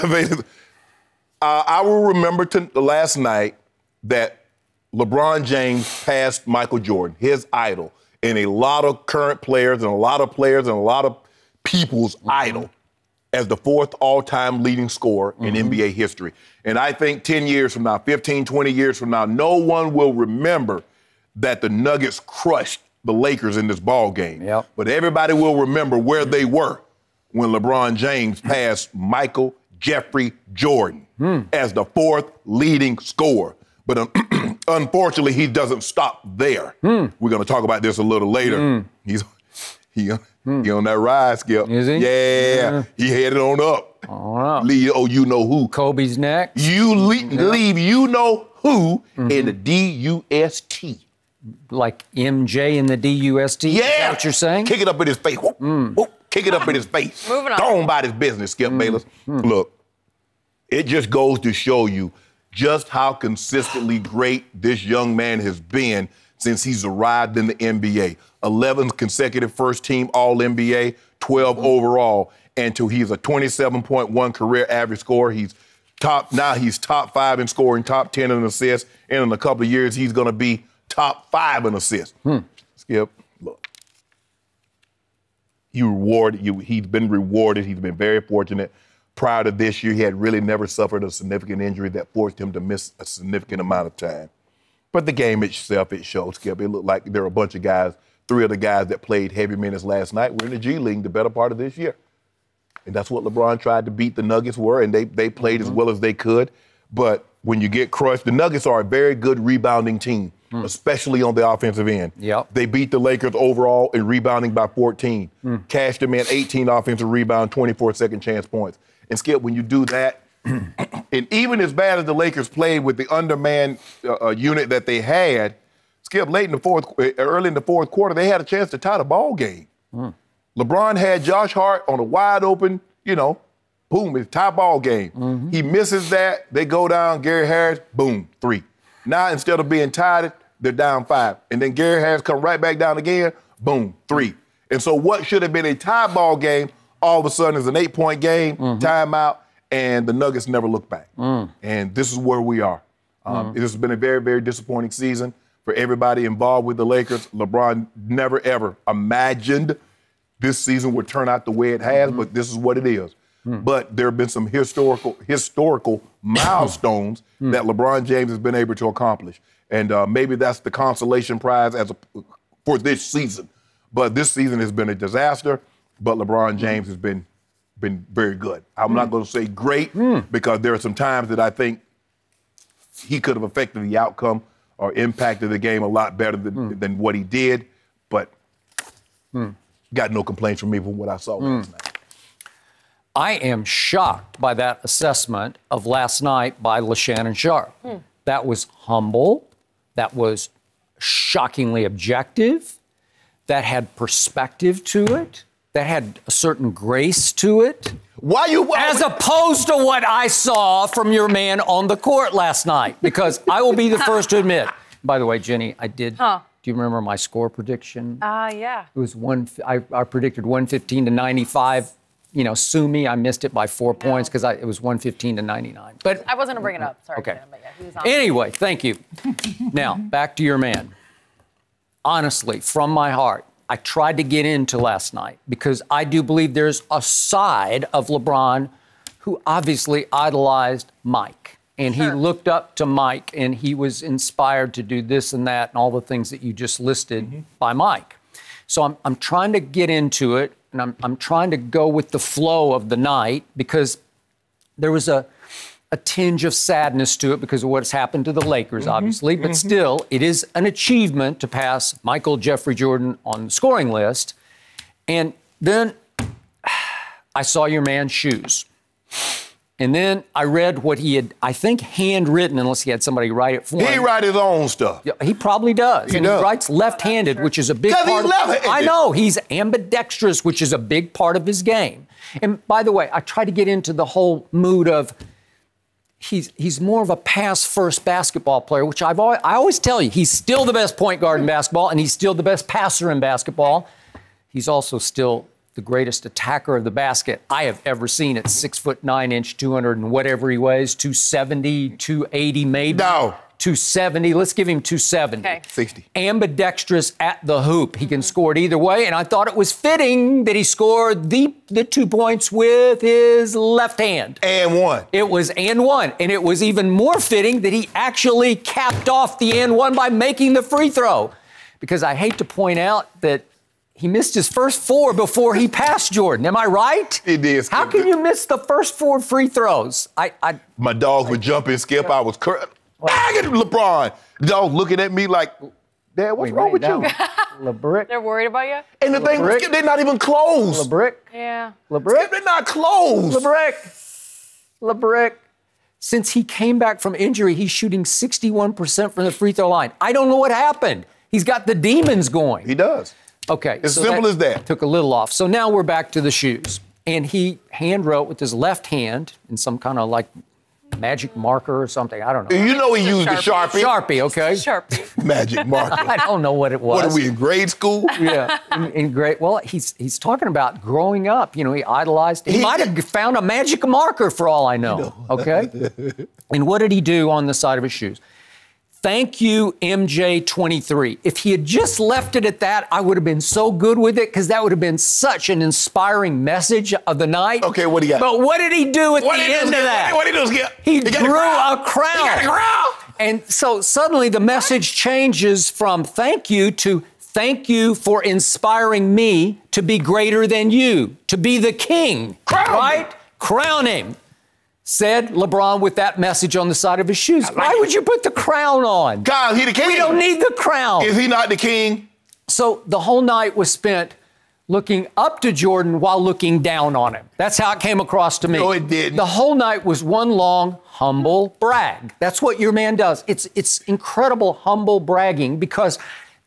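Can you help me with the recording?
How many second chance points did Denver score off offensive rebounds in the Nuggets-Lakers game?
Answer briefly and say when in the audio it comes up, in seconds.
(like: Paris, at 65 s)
24, at 117 s.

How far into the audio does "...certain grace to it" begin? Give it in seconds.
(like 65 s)
206 s.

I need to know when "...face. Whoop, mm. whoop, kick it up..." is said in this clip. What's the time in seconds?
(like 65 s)
55 s.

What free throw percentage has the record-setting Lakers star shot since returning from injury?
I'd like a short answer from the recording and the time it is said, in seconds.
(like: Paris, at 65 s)
61%, at 348 s.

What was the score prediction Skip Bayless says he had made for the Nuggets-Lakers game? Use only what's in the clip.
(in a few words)
115 to 95.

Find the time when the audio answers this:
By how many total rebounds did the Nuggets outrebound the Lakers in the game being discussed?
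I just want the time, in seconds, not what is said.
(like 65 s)
114 s.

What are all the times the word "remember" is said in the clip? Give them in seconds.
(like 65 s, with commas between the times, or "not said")
2 s, 20 s, 25 s, 216 s.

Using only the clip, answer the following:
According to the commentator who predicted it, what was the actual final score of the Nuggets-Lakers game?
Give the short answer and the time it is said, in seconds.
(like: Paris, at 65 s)
115 to 99, at 224 s.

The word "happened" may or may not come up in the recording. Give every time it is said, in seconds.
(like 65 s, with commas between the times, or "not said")
257 s, 350 s.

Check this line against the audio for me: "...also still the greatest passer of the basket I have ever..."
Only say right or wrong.
wrong.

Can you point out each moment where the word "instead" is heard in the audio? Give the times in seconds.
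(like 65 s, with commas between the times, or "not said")
139 s.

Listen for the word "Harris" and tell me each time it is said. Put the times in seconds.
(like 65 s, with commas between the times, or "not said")
137 s, 142 s.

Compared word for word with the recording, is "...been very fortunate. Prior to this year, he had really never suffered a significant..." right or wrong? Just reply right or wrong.
right.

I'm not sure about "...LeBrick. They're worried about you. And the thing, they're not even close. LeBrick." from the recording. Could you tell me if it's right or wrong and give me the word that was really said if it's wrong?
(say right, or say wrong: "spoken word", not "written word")
right.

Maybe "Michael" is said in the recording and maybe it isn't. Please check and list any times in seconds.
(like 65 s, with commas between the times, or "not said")
6 s, 28 s, 262 s.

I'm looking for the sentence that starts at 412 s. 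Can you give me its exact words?
So the whole night was spent looking up to Jordan while looking down on him.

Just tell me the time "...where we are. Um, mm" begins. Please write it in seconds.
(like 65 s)
152 s.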